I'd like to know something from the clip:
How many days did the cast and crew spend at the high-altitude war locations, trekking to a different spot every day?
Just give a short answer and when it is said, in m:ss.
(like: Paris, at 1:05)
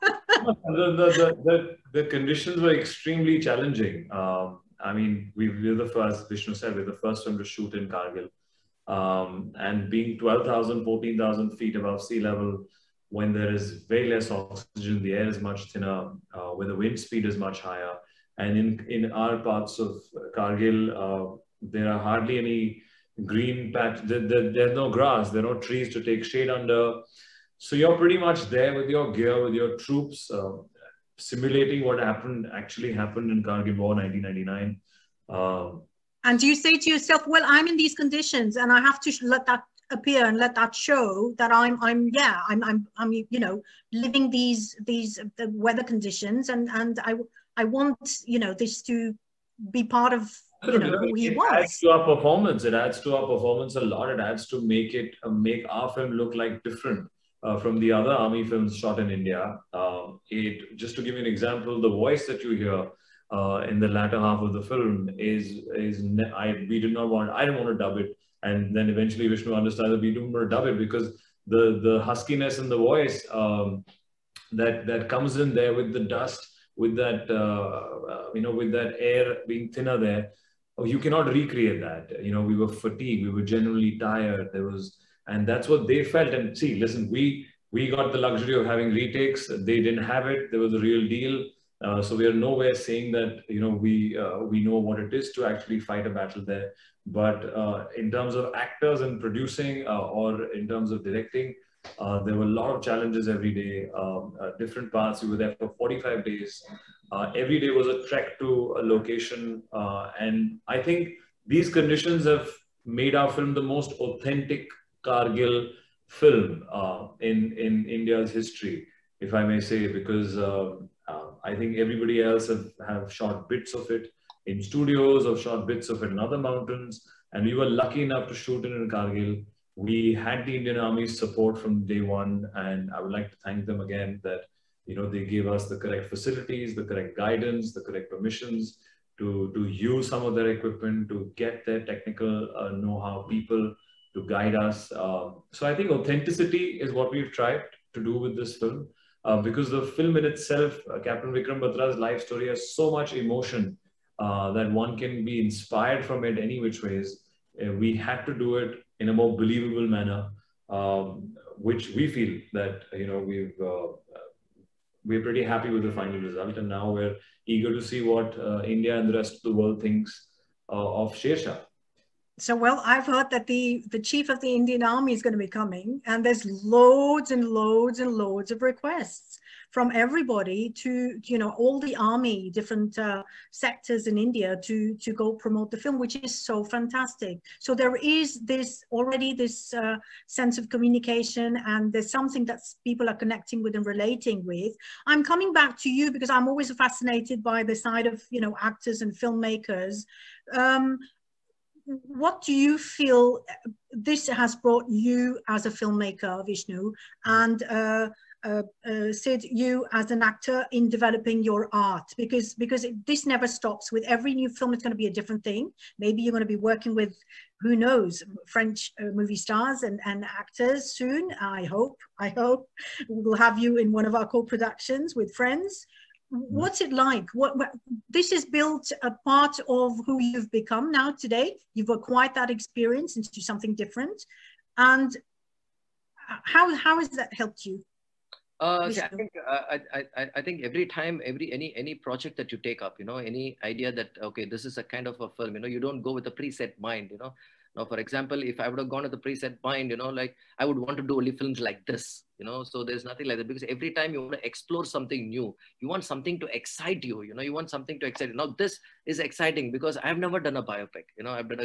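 45, at 1:45.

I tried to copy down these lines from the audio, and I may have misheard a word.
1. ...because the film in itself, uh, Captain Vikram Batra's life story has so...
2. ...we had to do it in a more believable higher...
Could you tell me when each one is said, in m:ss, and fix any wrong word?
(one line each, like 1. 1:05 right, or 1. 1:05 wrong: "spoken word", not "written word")
1. 2:29 right
2. 2:37 wrong: "manner", not "higher".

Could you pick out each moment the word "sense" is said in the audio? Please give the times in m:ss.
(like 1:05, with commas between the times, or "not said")
3:10.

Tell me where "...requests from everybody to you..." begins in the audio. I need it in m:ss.
2:58.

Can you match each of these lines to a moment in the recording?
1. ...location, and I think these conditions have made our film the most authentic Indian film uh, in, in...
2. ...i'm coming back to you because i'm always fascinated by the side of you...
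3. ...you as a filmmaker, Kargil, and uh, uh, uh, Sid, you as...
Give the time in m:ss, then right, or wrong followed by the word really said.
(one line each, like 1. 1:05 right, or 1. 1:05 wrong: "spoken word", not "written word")
1. 1:48 wrong: "Kargil", not "Indian"
2. 3:15 right
3. 3:24 wrong: "Vishnu", not "Kargil".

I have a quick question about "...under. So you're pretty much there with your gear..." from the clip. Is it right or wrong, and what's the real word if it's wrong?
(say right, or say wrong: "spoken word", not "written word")
right.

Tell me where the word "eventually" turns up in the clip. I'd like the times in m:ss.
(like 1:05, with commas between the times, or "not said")
1:08.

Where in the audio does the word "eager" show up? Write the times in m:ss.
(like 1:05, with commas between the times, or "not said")
2:47.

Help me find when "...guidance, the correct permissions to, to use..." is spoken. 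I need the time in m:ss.
2:17.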